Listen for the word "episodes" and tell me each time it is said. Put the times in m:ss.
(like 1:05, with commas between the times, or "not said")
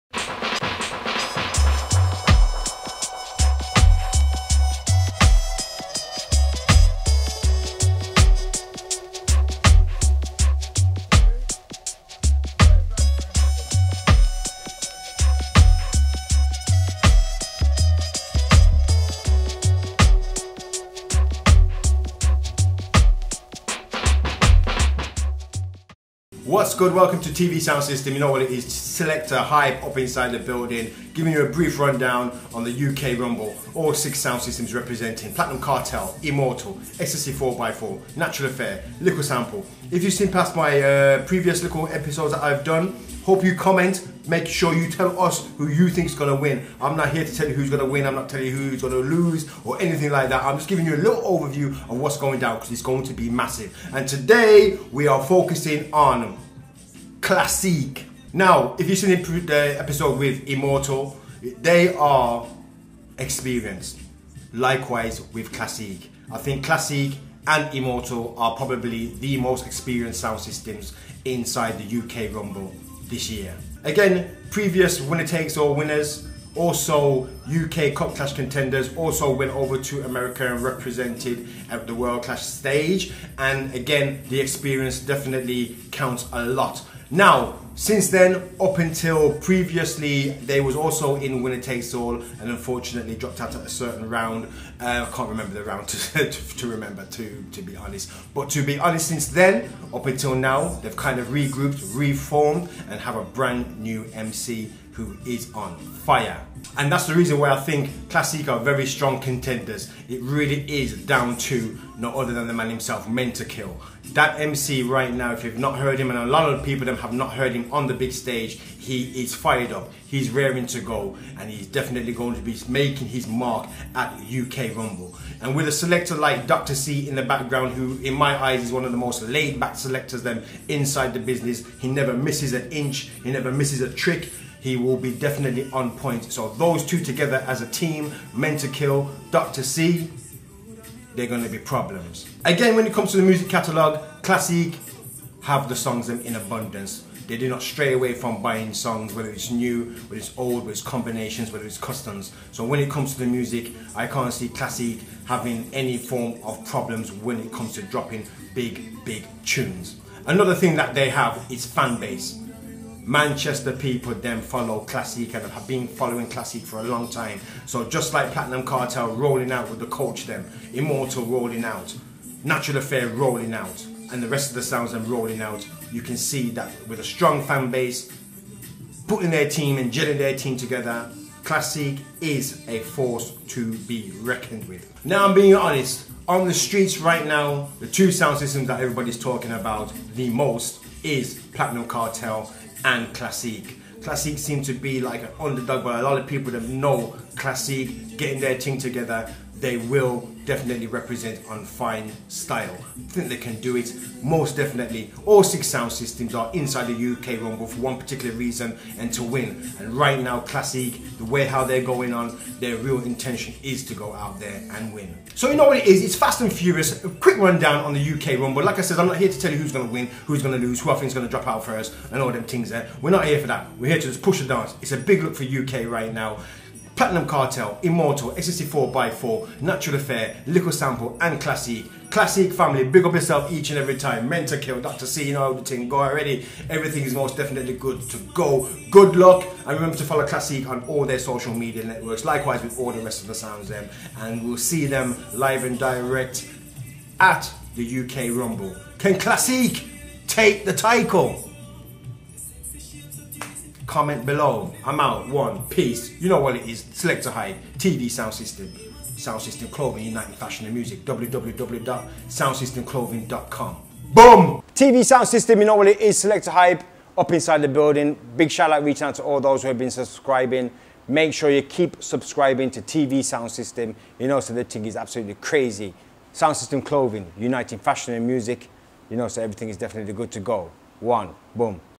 0:41, 0:59.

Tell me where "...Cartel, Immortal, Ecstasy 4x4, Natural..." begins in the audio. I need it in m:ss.
0:35.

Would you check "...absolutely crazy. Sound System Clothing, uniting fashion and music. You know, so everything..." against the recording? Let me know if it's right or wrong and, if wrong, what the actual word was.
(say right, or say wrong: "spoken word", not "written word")
right.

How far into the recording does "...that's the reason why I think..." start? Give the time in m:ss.
1:46.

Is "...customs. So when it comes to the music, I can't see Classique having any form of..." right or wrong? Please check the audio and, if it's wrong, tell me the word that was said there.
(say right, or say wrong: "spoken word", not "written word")
right.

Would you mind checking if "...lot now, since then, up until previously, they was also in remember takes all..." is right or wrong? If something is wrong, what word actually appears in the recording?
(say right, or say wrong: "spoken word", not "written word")
wrong: "winner", not "remember".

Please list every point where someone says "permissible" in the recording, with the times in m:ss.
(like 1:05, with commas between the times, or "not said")
not said.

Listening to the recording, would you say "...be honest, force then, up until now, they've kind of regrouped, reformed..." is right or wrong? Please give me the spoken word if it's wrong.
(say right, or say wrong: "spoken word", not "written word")
wrong: "since", not "force".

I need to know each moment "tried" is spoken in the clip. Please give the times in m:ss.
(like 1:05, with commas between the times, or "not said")
not said.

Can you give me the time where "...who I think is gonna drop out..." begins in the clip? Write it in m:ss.
3:40.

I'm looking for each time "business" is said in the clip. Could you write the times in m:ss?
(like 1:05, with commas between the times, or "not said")
2:11.